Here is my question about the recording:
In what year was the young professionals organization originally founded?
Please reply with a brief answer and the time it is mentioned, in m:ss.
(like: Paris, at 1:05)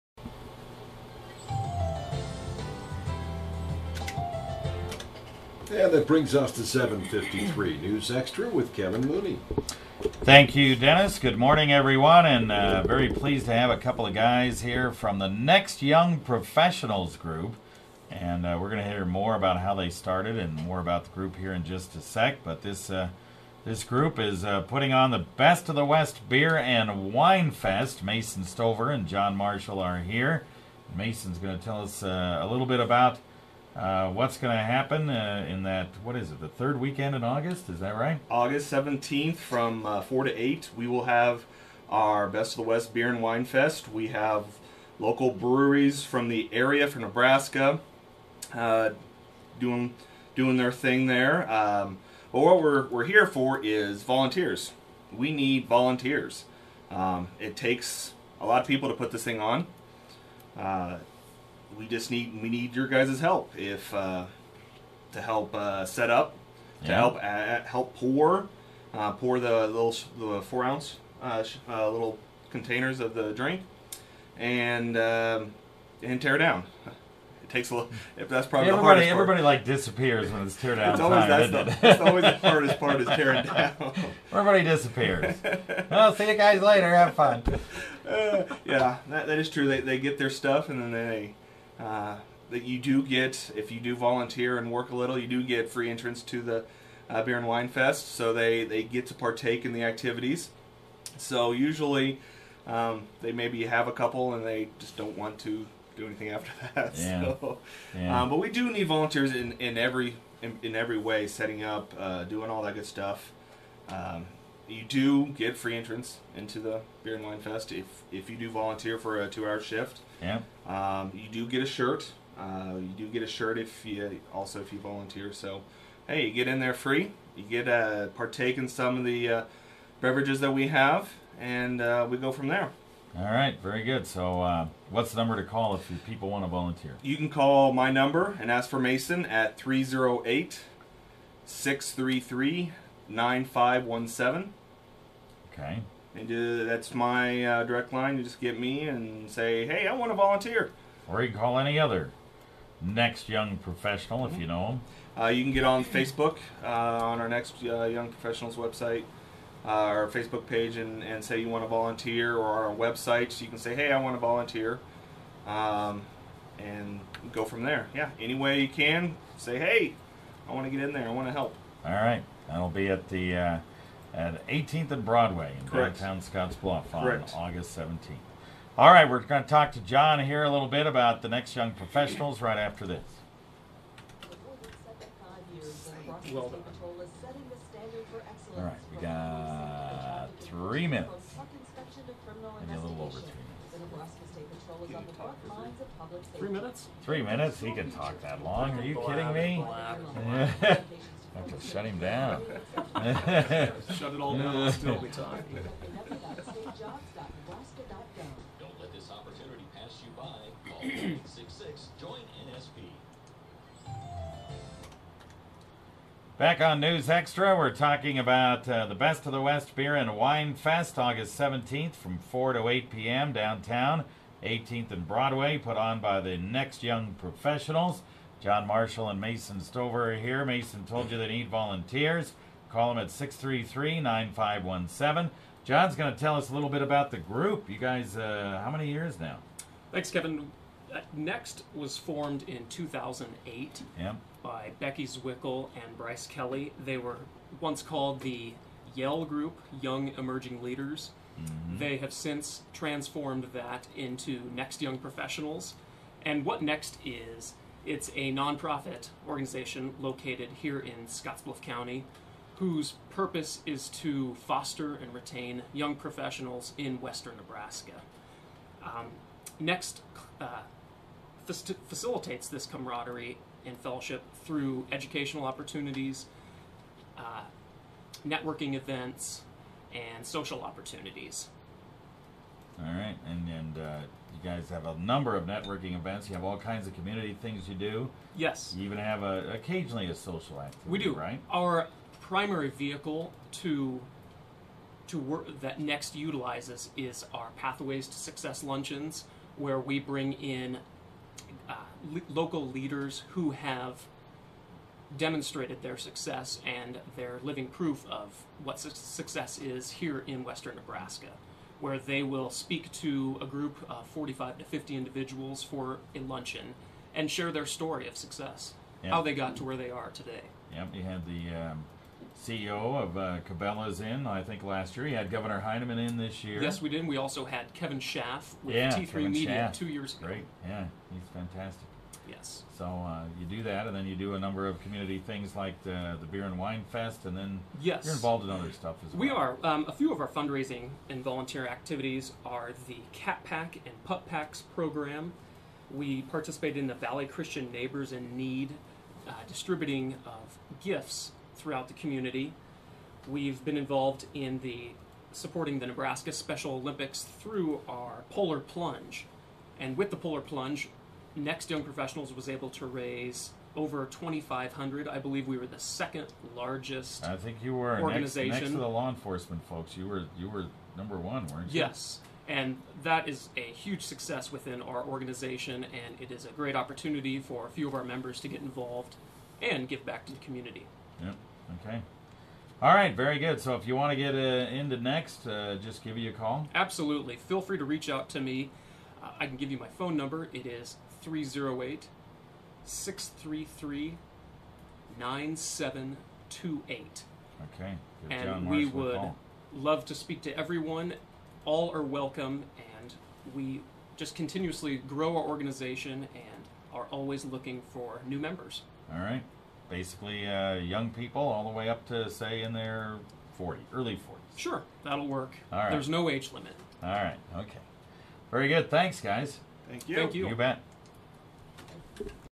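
2008, at 4:02.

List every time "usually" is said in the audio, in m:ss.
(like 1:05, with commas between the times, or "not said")
1:41.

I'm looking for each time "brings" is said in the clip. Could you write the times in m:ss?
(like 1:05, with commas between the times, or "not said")
0:06, 4:59.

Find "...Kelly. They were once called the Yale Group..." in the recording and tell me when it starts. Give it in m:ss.
4:06.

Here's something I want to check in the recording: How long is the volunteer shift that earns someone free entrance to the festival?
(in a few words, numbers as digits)
2 hours.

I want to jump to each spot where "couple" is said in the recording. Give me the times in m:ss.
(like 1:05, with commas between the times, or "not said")
0:13, 1:43.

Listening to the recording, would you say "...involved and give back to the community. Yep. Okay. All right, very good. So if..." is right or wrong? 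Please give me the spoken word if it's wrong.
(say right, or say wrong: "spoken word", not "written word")
right.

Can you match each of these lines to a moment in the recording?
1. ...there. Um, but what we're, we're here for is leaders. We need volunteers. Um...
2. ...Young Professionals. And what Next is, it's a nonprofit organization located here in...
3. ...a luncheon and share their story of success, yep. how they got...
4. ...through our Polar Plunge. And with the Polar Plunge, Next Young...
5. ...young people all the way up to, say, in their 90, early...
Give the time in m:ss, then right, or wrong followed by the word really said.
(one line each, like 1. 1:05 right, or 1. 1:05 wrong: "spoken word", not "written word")
1. 0:51 wrong: "volunteers", not "leaders"
2. 4:14 right
3. 5:16 right
4. 5:57 right
5. 6:50 wrong: "40", not "90".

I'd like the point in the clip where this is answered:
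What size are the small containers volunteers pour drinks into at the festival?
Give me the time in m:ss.
1:10.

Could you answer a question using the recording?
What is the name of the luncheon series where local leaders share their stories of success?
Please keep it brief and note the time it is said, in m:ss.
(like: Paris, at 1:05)
Pathways to Success, at 4:57.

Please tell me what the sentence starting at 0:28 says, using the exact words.
Mason Stover and John Marshall are here.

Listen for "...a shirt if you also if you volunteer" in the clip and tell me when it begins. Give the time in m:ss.
2:03.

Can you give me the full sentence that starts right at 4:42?
All right, and and uh, you guys have a number of networking events.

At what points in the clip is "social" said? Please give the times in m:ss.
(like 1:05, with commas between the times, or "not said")
4:40, 4:50.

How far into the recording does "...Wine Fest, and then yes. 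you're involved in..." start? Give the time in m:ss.
5:36.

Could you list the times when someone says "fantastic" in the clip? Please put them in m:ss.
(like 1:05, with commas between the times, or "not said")
5:31.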